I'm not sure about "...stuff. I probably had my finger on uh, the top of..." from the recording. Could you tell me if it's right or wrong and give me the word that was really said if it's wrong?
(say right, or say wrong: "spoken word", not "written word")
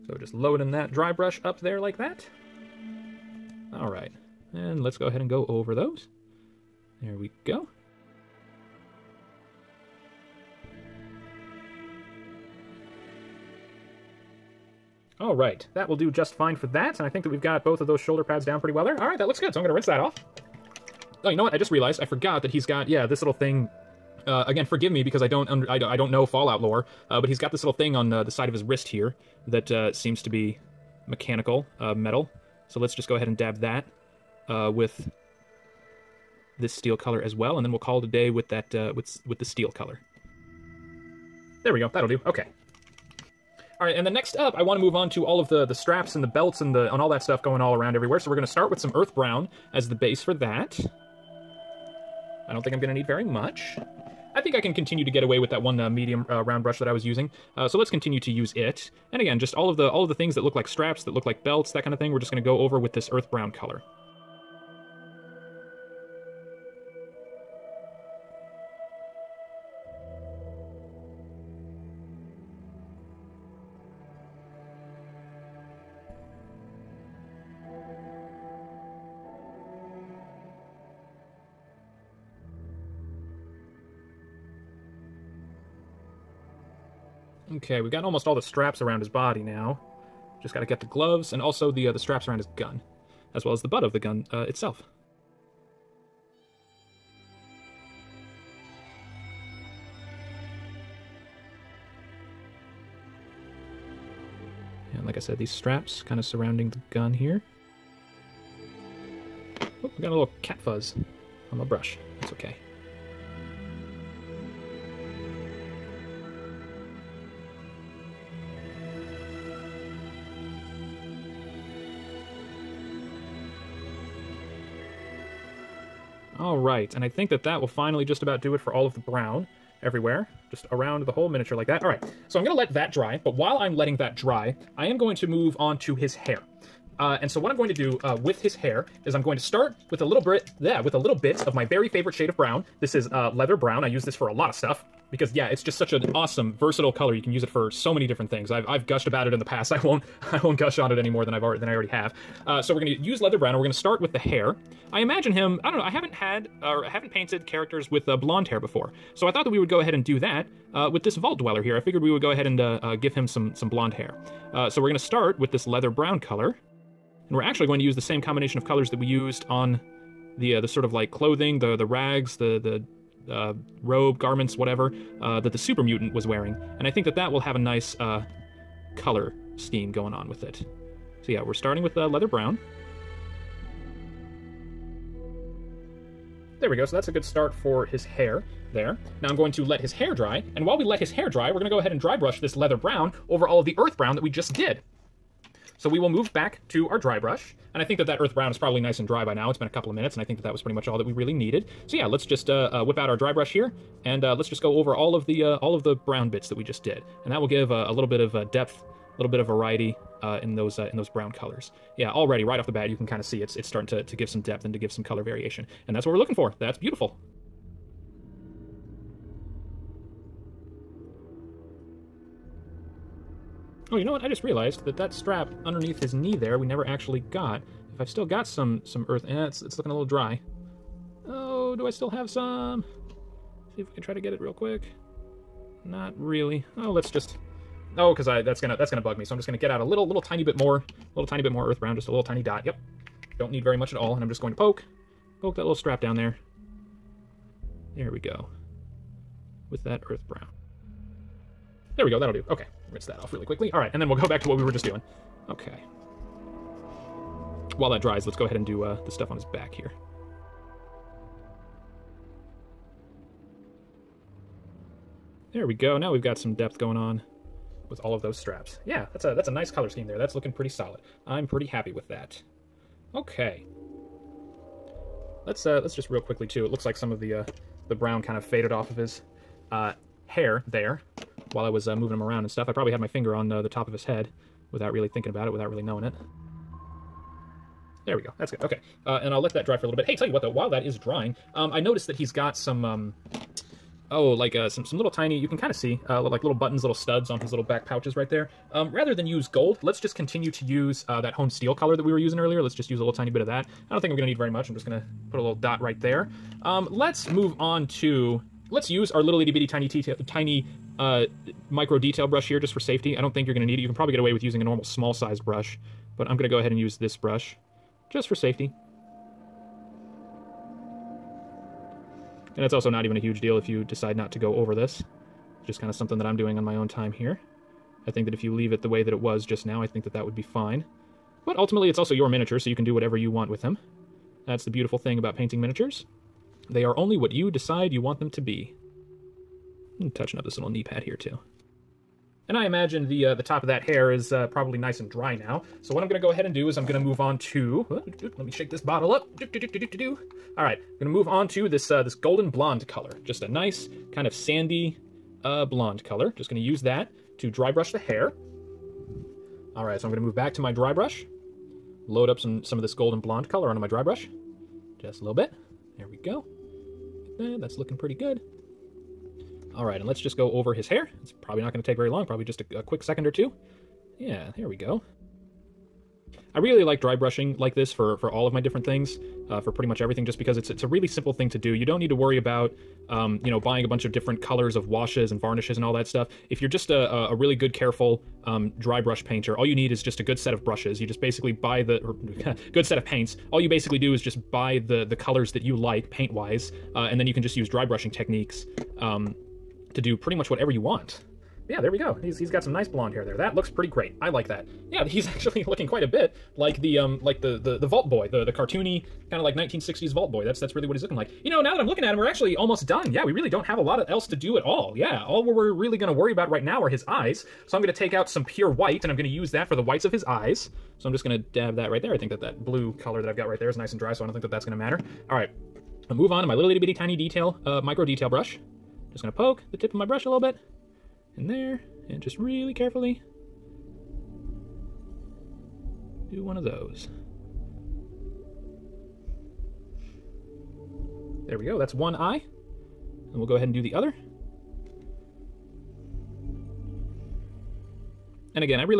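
right.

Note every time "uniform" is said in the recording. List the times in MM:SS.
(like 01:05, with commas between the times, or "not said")
not said.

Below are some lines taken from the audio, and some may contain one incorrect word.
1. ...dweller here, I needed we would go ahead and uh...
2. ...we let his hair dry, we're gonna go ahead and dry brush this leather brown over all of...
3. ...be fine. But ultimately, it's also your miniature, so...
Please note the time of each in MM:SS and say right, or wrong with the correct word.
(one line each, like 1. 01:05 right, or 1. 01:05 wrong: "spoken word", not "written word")
1. 02:41 wrong: "figured", not "needed"
2. 03:10 right
3. 05:30 right.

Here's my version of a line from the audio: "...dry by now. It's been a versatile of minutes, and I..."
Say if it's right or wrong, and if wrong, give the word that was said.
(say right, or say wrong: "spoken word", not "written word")
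wrong: "couple", not "versatile".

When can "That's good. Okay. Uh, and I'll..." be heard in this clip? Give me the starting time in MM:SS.
04:48.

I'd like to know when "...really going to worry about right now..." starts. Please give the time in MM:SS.
06:55.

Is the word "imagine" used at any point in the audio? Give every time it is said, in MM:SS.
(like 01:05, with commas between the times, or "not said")
02:34, 05:42.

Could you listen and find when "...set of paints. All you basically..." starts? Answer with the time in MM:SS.
06:32.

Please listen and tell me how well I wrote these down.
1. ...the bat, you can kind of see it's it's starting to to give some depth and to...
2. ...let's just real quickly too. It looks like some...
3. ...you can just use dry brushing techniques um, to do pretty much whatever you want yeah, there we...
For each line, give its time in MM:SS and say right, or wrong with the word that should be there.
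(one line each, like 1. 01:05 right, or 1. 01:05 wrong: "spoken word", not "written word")
1. 03:32 right
2. 04:35 right
3. 06:37 right.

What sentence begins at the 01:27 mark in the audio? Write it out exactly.
Okay, we've got almost all the straps around his body now.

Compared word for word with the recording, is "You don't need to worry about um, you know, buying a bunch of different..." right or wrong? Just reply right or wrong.
right.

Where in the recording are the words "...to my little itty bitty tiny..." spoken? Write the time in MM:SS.
07:06.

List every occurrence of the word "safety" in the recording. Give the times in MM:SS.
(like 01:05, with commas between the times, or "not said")
05:12, 05:18.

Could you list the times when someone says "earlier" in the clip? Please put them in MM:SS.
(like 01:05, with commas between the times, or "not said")
05:02.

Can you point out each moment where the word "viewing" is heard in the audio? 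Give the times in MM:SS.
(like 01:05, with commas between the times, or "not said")
not said.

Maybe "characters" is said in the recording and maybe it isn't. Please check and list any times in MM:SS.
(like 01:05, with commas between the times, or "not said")
02:37.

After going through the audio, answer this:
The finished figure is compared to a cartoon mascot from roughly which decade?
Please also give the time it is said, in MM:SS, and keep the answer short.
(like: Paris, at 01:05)
1960s, at 06:49.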